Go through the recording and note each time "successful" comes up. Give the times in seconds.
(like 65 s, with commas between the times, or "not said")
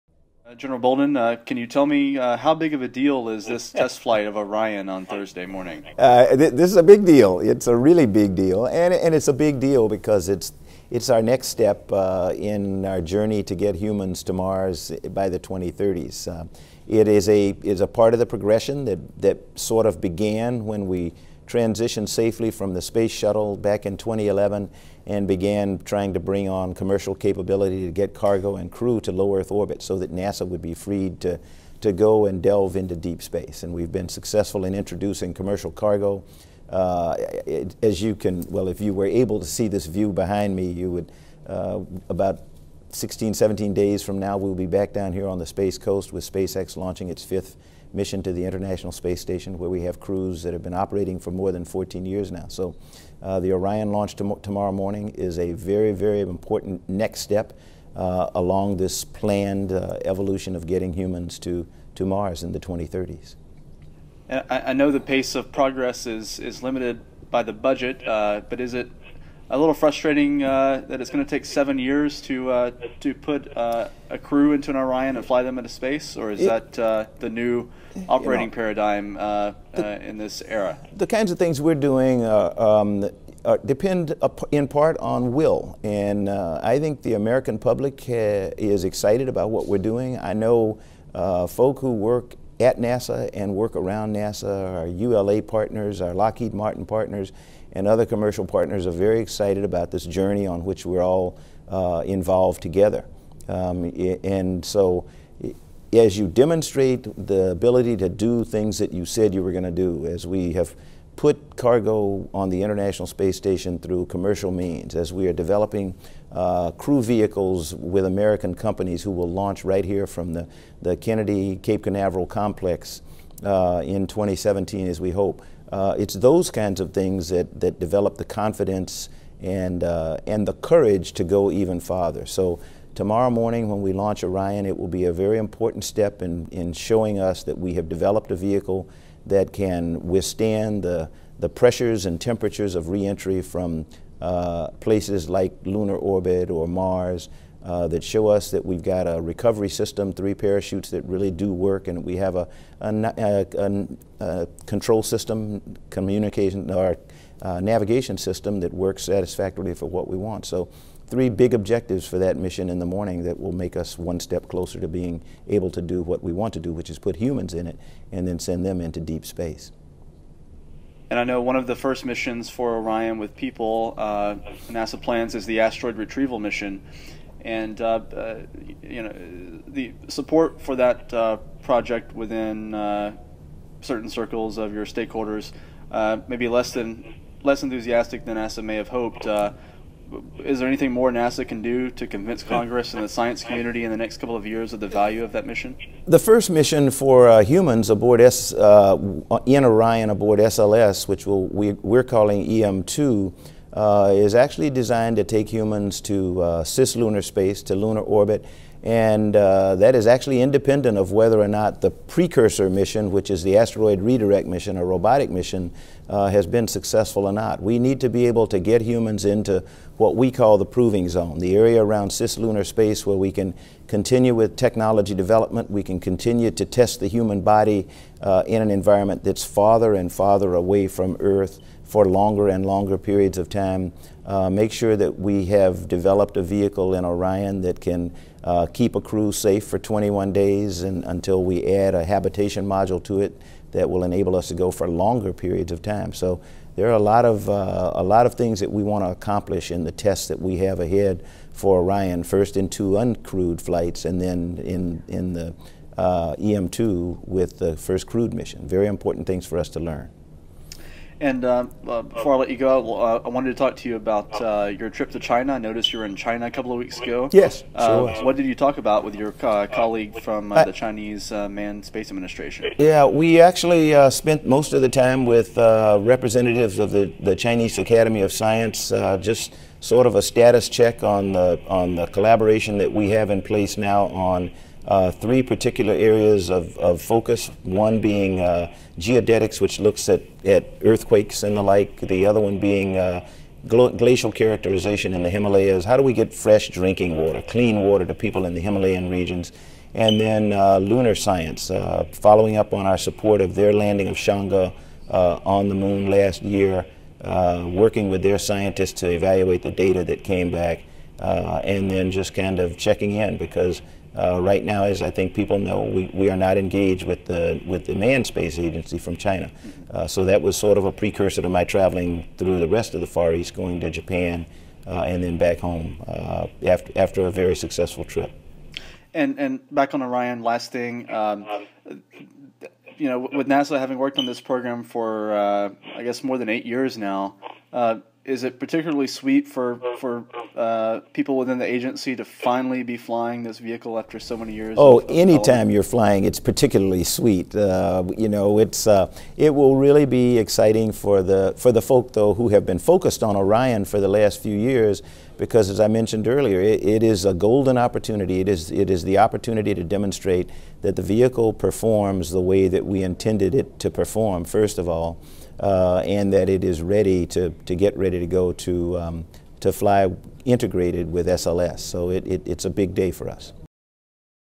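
34 s, 216 s, 327 s.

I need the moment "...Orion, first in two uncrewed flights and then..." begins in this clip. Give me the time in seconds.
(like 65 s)
251 s.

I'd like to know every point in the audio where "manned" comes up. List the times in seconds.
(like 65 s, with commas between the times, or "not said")
271 s, 317 s.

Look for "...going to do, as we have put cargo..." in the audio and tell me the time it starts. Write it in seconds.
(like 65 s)
109 s.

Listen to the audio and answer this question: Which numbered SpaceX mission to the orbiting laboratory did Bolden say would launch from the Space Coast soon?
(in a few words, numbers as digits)
5th.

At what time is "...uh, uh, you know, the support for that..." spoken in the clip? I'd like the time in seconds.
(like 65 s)
177 s.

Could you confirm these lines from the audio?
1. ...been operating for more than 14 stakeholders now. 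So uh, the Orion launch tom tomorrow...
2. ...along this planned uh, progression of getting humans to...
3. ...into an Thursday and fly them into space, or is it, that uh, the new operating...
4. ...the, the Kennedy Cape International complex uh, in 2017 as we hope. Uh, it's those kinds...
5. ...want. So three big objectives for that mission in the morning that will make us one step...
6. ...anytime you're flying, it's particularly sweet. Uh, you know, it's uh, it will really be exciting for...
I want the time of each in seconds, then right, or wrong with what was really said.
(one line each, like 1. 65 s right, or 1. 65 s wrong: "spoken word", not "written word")
1. 50 s wrong: "years", not "stakeholders"
2. 58 s wrong: "evolution", not "progression"
3. 74 s wrong: "Orion", not "Thursday"
4. 120 s wrong: "Canaveral", not "International"
5. 160 s right
6. 345 s right.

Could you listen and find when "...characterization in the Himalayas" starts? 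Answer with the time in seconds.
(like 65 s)
294 s.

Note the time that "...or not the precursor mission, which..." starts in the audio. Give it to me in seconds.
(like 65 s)
211 s.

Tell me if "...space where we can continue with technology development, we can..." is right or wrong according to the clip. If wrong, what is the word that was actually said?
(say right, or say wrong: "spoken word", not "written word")
right.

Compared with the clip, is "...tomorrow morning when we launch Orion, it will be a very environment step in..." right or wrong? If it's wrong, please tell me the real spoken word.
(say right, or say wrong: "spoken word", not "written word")
wrong: "important", not "environment".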